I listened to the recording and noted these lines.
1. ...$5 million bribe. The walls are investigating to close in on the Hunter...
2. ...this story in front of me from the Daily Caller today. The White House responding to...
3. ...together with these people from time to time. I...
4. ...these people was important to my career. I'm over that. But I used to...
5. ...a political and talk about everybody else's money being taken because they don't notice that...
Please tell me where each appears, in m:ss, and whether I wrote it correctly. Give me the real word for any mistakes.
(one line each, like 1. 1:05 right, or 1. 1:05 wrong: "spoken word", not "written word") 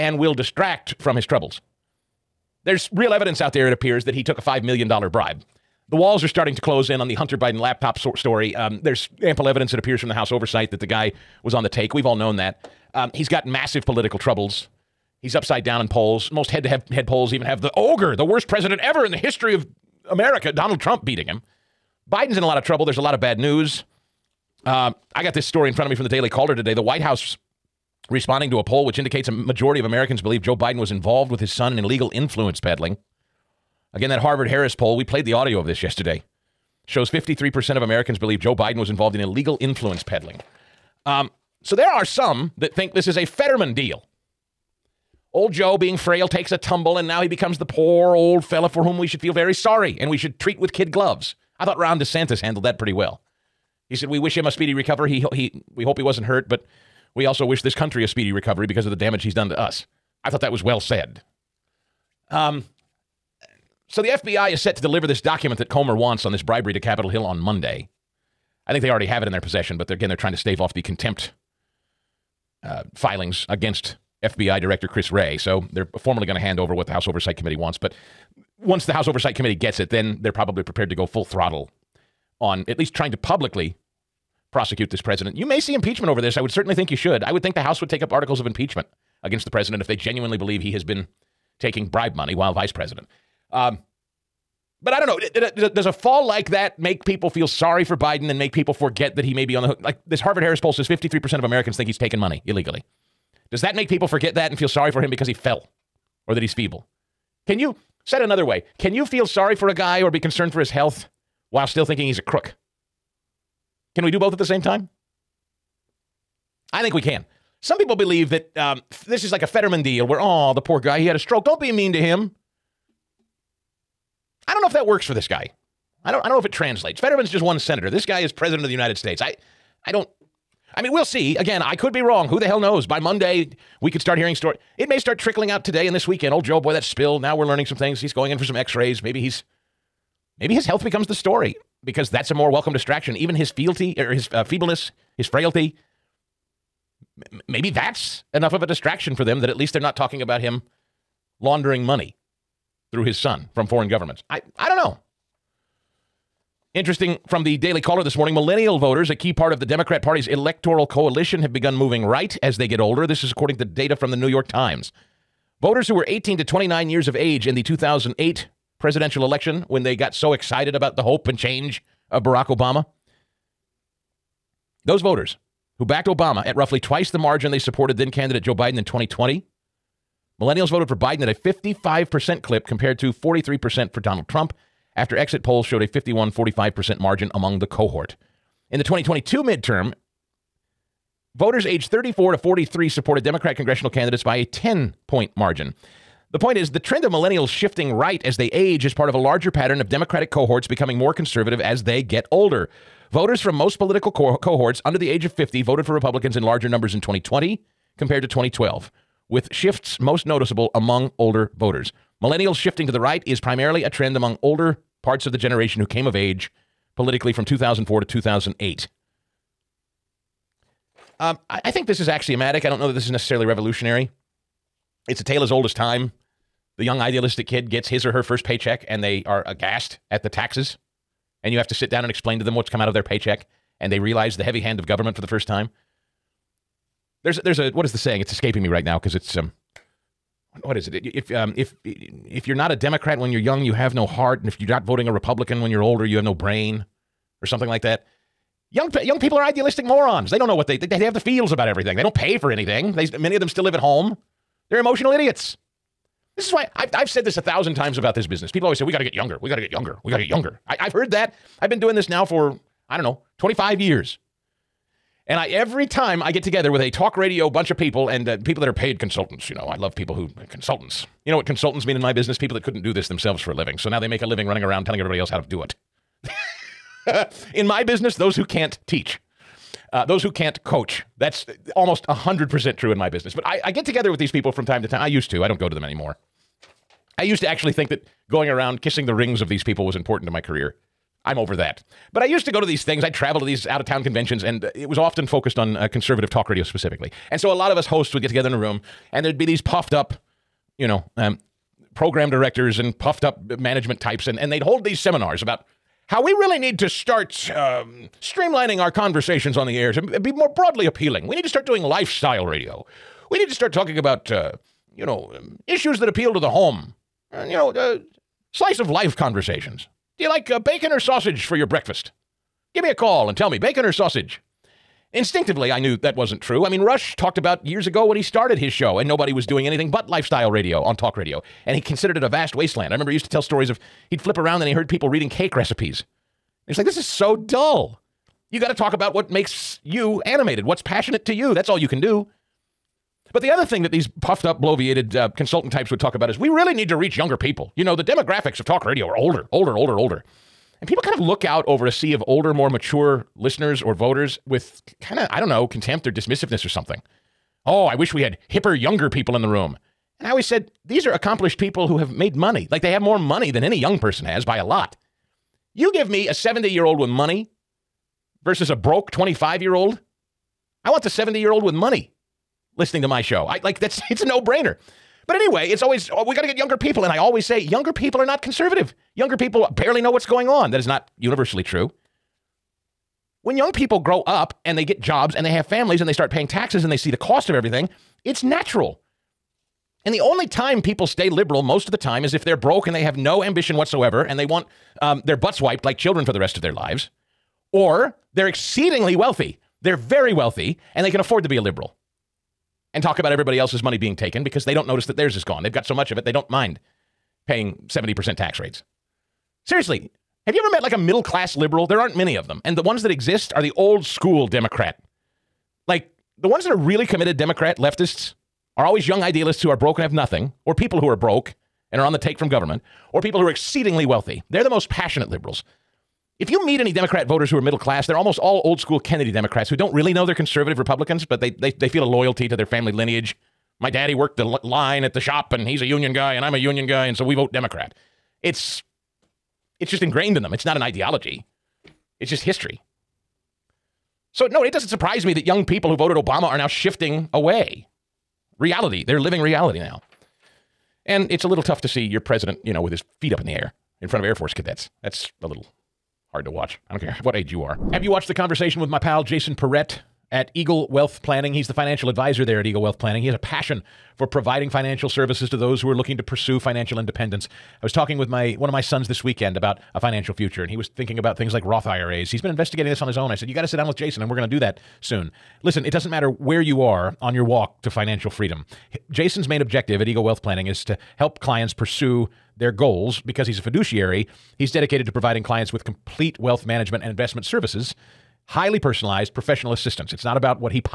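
1. 0:04 wrong: "starting", not "investigating"
2. 0:25 right
3. 4:43 right
4. 4:49 right
5. 6:41 wrong: "liberal", not "political".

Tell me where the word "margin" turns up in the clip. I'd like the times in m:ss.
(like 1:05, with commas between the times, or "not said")
2:57, 3:06, 3:15.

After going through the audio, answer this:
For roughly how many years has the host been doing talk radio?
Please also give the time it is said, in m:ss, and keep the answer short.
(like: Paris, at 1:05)
25 years, at 4:23.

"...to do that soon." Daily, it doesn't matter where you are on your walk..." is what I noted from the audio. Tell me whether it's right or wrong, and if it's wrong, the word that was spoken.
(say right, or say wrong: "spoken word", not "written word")
wrong: "Listen", not "Daily".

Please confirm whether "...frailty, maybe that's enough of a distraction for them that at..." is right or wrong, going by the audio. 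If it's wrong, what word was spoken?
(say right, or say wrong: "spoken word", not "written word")
right.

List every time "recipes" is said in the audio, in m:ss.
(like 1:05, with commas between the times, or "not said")
5:35.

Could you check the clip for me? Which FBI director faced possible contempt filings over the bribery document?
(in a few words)
Chris Wray.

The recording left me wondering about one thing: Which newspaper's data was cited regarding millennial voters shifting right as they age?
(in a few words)
New York Times.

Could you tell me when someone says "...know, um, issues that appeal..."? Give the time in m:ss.
5:15.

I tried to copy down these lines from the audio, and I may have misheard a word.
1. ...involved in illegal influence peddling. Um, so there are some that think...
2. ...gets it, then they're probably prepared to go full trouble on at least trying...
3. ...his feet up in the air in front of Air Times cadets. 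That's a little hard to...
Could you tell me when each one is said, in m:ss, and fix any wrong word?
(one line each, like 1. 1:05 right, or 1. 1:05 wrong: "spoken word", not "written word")
1. 0:38 right
2. 1:19 wrong: "throttle", not "trouble"
3. 7:32 wrong: "Force", not "Times".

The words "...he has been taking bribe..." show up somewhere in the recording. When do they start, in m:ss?
1:30.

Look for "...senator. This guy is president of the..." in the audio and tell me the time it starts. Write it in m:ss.
2:07.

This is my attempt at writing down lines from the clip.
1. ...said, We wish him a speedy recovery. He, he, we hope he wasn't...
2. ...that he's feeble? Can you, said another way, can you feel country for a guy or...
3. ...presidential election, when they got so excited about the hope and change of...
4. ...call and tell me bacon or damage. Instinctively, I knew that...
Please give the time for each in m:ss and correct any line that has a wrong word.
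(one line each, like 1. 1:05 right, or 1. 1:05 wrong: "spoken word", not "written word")
1. 0:53 right
2. 1:46 wrong: "sorry", not "country"
3. 2:48 right
4. 5:22 wrong: "sausage", not "damage".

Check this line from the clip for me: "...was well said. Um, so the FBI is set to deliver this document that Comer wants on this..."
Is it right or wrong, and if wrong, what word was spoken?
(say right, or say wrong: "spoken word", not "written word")
right.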